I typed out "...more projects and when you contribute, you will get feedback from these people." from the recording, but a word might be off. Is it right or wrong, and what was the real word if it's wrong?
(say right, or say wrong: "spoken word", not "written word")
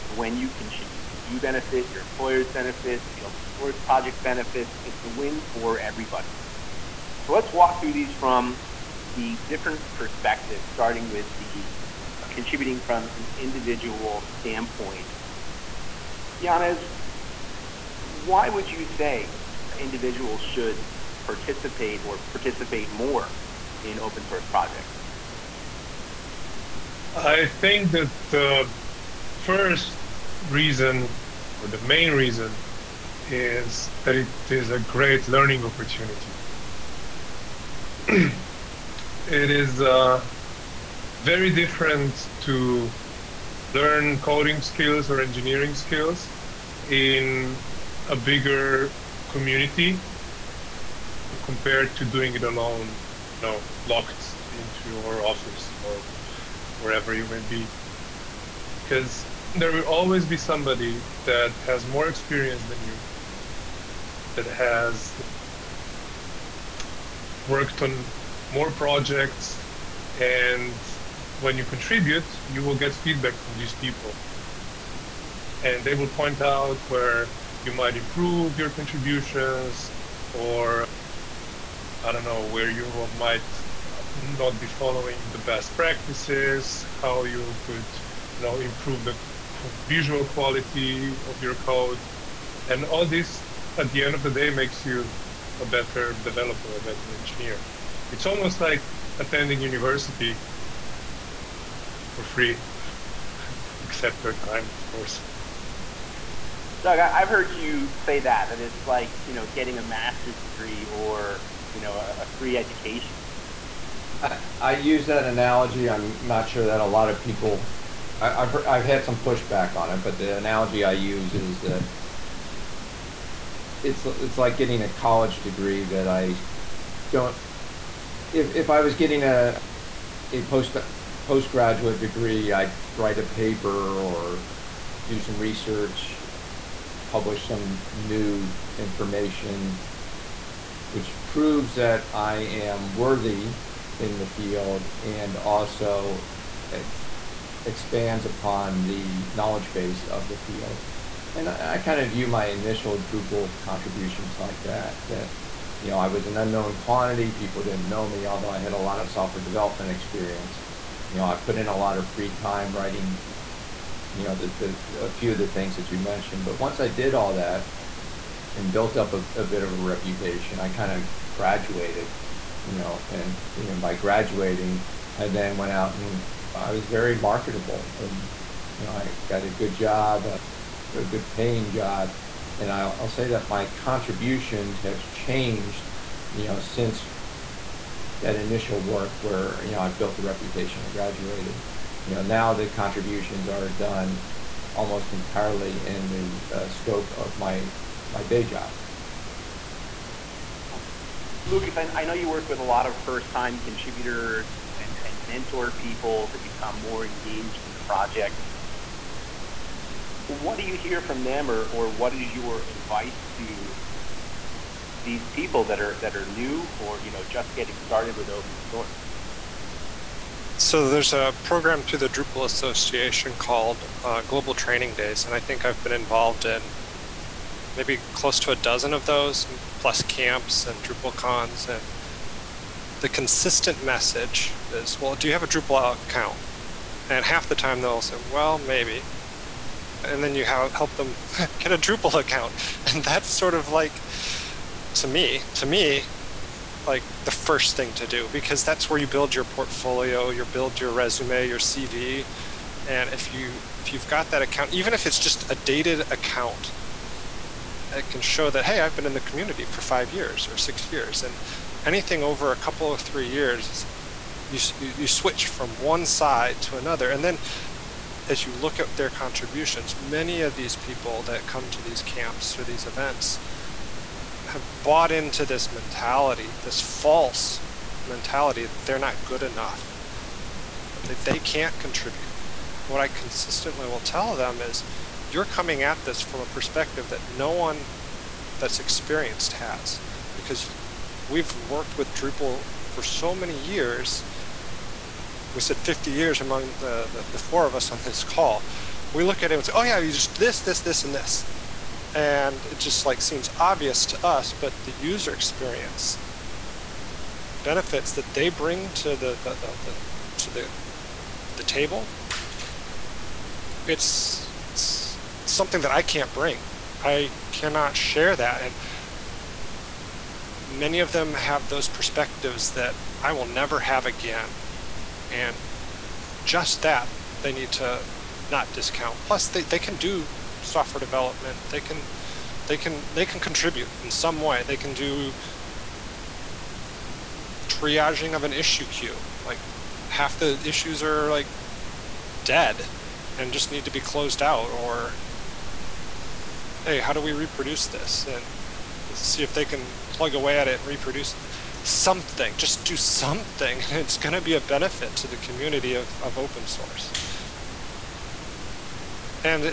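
right.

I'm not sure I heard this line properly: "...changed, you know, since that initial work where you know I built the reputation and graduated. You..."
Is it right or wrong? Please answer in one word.
right.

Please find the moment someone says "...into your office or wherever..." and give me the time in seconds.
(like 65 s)
54 s.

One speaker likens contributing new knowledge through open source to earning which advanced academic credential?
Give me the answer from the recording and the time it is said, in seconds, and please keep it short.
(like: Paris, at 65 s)
postgraduate degree, at 130 s.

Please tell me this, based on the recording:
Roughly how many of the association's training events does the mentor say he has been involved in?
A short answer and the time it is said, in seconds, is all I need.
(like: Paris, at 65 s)
close to a dozen, at 228 s.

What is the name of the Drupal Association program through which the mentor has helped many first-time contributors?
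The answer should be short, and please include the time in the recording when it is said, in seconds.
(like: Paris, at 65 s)
Global Training Days, at 224 s.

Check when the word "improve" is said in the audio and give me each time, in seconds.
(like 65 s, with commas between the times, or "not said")
77 s, 88 s.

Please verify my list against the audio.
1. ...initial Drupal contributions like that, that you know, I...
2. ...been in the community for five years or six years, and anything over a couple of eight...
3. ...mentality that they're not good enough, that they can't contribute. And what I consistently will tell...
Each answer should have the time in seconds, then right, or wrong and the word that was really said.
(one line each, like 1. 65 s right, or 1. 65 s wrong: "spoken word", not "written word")
1. 152 s right
2. 258 s wrong: "three", not "eight"
3. 278 s right.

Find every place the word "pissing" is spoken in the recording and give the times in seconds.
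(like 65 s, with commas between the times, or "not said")
not said.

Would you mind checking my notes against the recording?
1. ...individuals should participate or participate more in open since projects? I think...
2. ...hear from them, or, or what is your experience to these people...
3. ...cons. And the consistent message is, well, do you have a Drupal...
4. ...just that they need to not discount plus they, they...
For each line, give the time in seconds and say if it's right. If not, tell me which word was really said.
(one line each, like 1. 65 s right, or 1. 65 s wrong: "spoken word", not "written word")
1. 19 s wrong: "source", not "since"
2. 210 s wrong: "advice", not "experience"
3. 231 s right
4. 326 s right.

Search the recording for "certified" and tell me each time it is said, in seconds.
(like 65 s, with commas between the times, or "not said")
not said.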